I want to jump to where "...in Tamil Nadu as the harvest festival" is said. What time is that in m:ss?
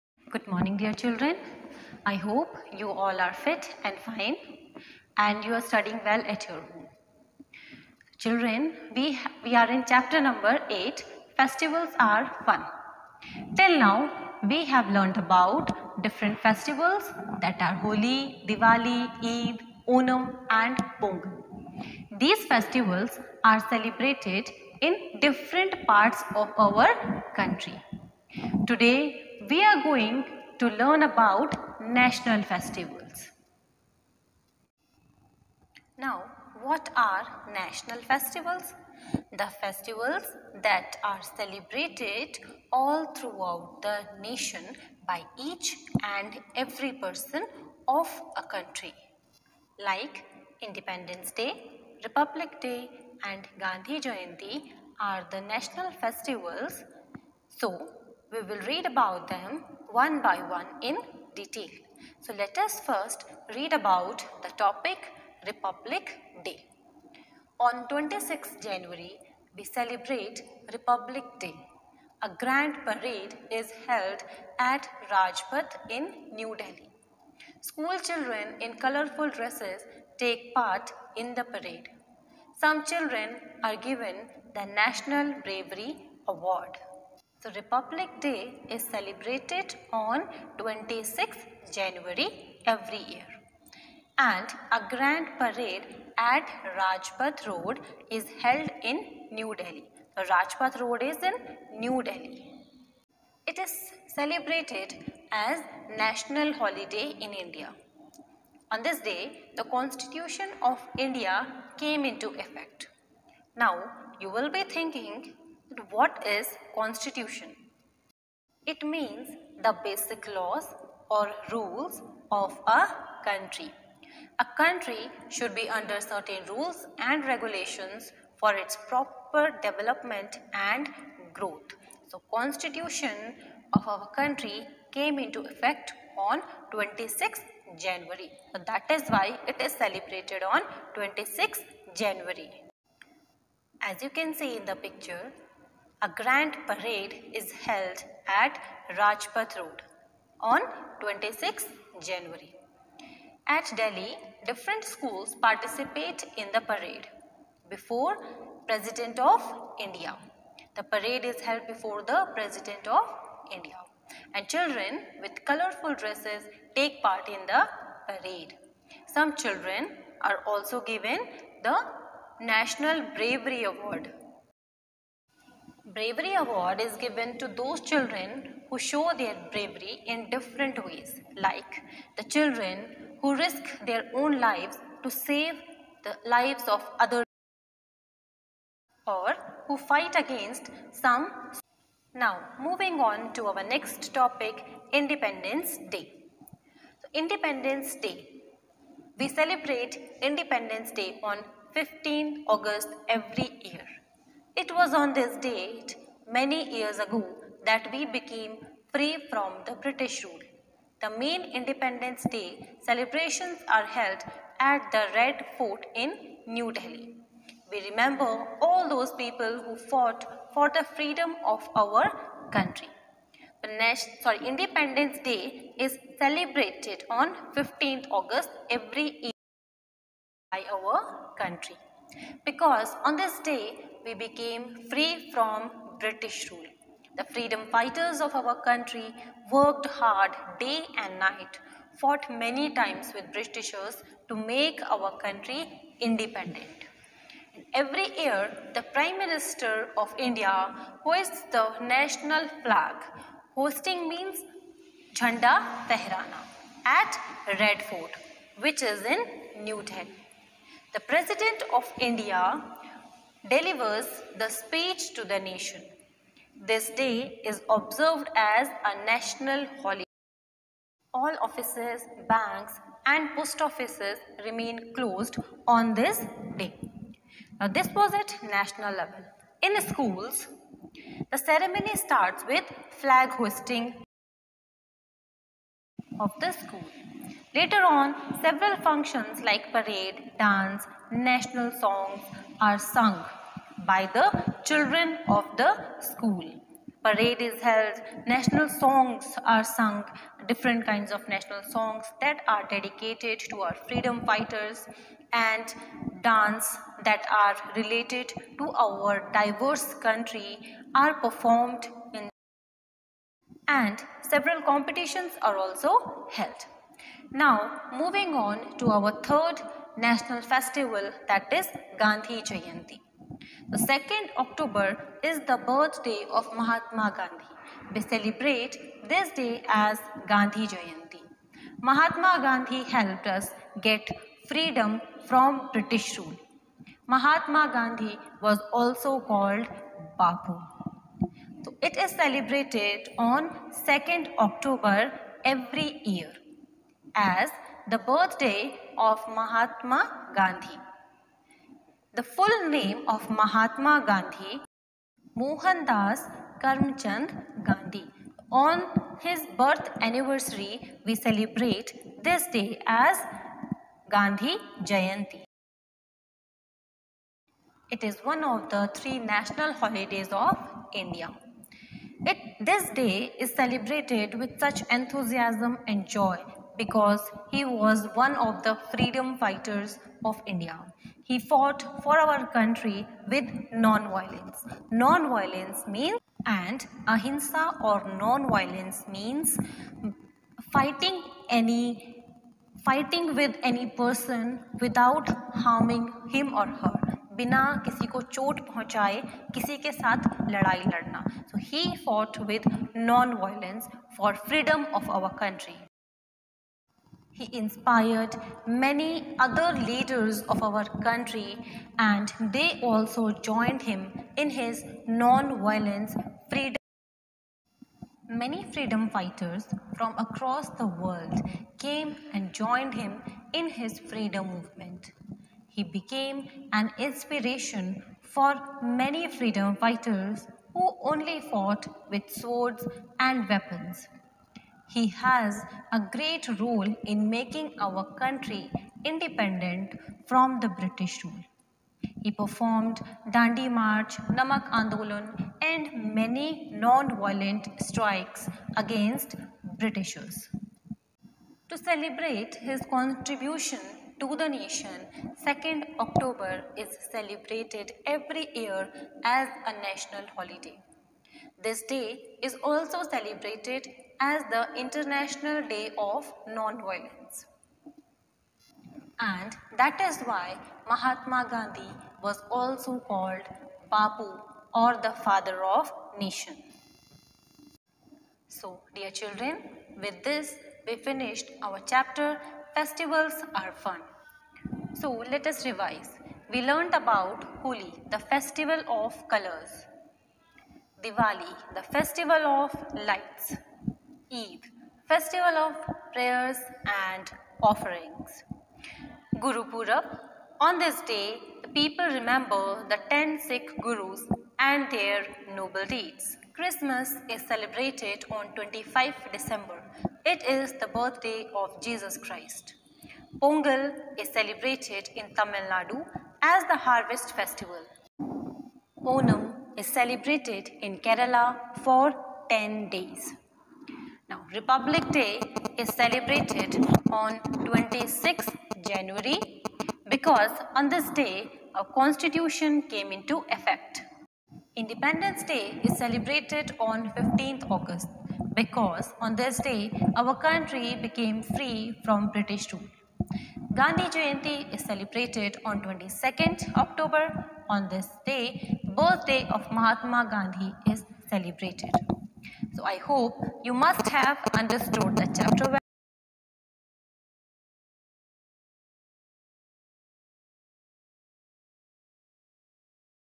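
8:35.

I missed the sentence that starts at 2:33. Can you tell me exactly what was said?
At Delhi, different schools participate in the parade.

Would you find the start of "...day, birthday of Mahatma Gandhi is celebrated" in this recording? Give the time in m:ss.
9:08.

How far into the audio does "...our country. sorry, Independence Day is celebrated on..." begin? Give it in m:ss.
3:41.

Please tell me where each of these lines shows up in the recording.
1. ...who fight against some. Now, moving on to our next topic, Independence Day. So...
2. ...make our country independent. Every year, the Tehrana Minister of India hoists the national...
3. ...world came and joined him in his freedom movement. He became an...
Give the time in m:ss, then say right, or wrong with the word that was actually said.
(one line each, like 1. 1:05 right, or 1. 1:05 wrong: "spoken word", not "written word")
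1. 3:09 right
2. 4:04 wrong: "Prime", not "Tehrana"
3. 7:00 right.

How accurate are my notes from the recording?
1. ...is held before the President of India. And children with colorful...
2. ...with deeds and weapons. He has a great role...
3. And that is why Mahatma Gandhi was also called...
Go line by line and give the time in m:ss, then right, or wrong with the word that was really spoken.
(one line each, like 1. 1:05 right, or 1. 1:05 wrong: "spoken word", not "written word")
1. 2:41 right
2. 7:12 wrong: "swords", not "deeds"
3. 7:49 right.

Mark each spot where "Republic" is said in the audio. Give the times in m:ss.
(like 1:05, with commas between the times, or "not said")
0:52, 1:05, 1:10, 1:27, 8:44.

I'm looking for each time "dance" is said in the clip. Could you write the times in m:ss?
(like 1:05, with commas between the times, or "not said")
4:50, 5:06.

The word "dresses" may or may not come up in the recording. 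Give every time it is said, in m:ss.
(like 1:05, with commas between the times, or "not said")
1:19, 2:45.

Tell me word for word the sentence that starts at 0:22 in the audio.
These festivals are celebrated in different parts of our country.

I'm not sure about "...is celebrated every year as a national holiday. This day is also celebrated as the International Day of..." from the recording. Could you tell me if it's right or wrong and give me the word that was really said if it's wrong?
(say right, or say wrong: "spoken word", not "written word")
right.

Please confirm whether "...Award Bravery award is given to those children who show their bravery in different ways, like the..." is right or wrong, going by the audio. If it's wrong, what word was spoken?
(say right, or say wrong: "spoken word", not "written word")
right.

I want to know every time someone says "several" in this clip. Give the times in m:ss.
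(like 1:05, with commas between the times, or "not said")
4:48, 5:14.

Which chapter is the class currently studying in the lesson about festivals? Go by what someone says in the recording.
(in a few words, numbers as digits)
8.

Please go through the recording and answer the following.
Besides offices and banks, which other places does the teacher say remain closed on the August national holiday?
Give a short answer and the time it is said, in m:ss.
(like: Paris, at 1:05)
Post offices, at 4:33.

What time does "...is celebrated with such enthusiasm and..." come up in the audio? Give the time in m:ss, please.
6:13.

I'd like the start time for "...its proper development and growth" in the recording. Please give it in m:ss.
2:08.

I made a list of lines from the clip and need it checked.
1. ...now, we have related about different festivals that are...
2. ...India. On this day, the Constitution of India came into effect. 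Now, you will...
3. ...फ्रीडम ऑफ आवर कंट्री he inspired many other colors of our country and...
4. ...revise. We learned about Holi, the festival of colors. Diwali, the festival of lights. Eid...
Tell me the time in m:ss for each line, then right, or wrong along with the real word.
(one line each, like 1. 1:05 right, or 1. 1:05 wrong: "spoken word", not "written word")
1. 0:13 wrong: "learned", not "related"
2. 1:47 right
3. 6:44 wrong: "leaders", not "colors"
4. 8:05 right.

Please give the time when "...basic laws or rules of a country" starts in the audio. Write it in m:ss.
1:59.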